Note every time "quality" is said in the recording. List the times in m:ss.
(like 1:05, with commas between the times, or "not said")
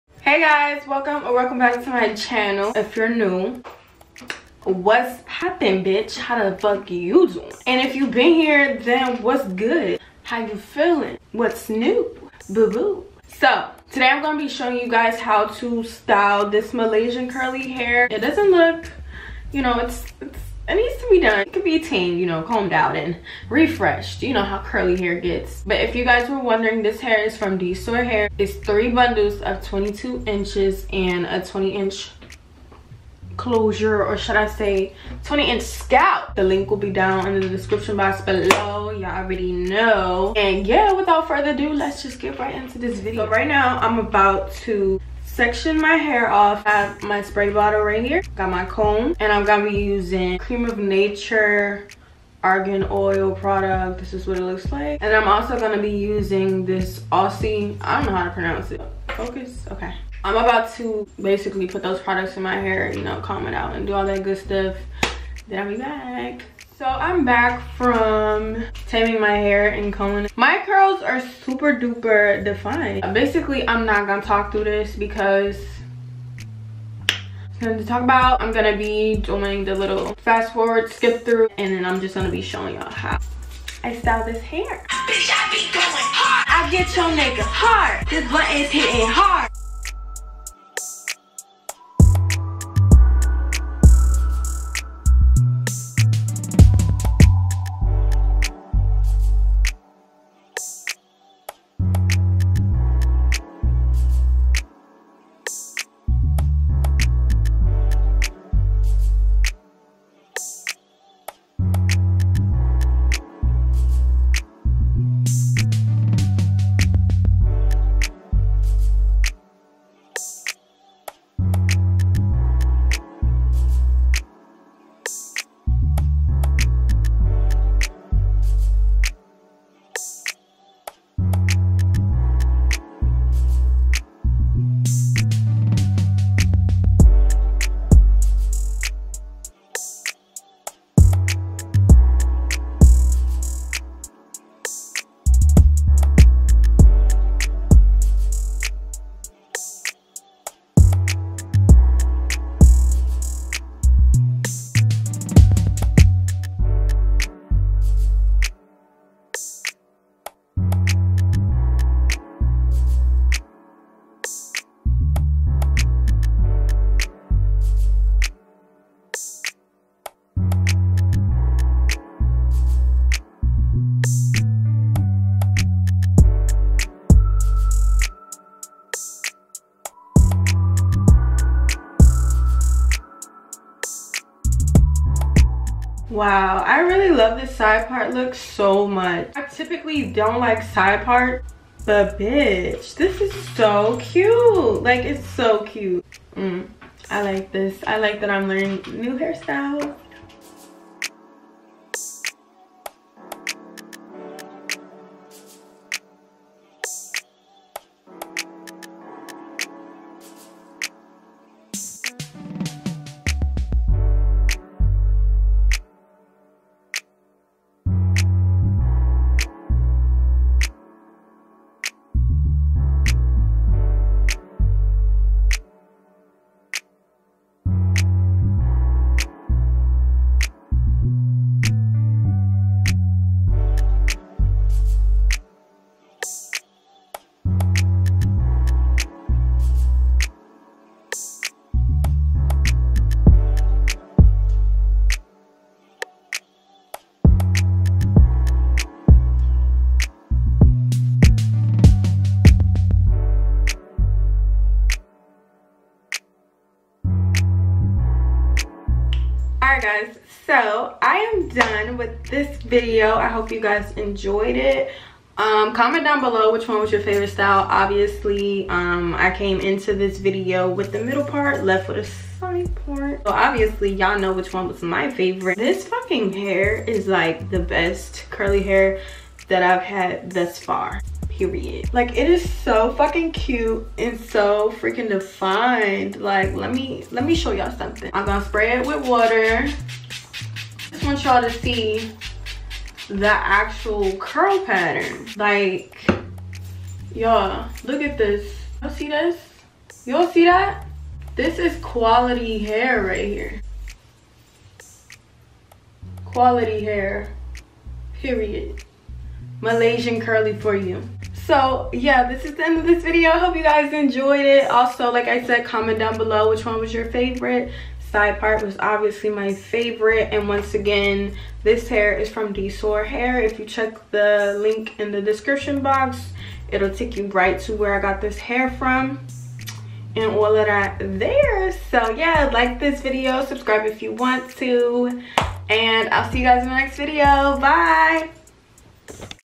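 5:01, 5:06.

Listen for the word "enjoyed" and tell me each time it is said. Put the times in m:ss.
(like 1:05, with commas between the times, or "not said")
4:23, 5:13.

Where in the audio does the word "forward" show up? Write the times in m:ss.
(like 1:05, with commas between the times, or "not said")
1:20.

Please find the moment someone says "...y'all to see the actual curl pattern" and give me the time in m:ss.
4:51.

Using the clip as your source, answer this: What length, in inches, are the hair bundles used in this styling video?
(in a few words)
22 inches.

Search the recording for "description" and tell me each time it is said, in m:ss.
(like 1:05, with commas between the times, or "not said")
0:37, 5:25.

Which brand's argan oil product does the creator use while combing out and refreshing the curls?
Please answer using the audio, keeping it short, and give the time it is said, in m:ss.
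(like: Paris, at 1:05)
Cream of Nature, at 0:50.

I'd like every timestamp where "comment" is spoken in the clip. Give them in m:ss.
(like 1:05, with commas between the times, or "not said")
4:25, 5:15.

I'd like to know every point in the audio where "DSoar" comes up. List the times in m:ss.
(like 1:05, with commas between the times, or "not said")
0:27, 5:22.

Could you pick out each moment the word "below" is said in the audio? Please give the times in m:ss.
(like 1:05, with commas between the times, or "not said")
0:38, 4:26, 5:16.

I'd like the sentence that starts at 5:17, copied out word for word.
Side part was obviously my favorite.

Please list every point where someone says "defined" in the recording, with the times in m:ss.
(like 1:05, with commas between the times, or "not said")
1:12, 4:45.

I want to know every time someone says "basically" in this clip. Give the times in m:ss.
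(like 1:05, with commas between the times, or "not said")
1:01, 1:13.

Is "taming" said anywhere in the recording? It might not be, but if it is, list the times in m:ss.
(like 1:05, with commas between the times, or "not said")
1:08.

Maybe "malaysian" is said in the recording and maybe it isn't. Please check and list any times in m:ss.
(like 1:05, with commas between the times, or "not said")
0:16, 5:09.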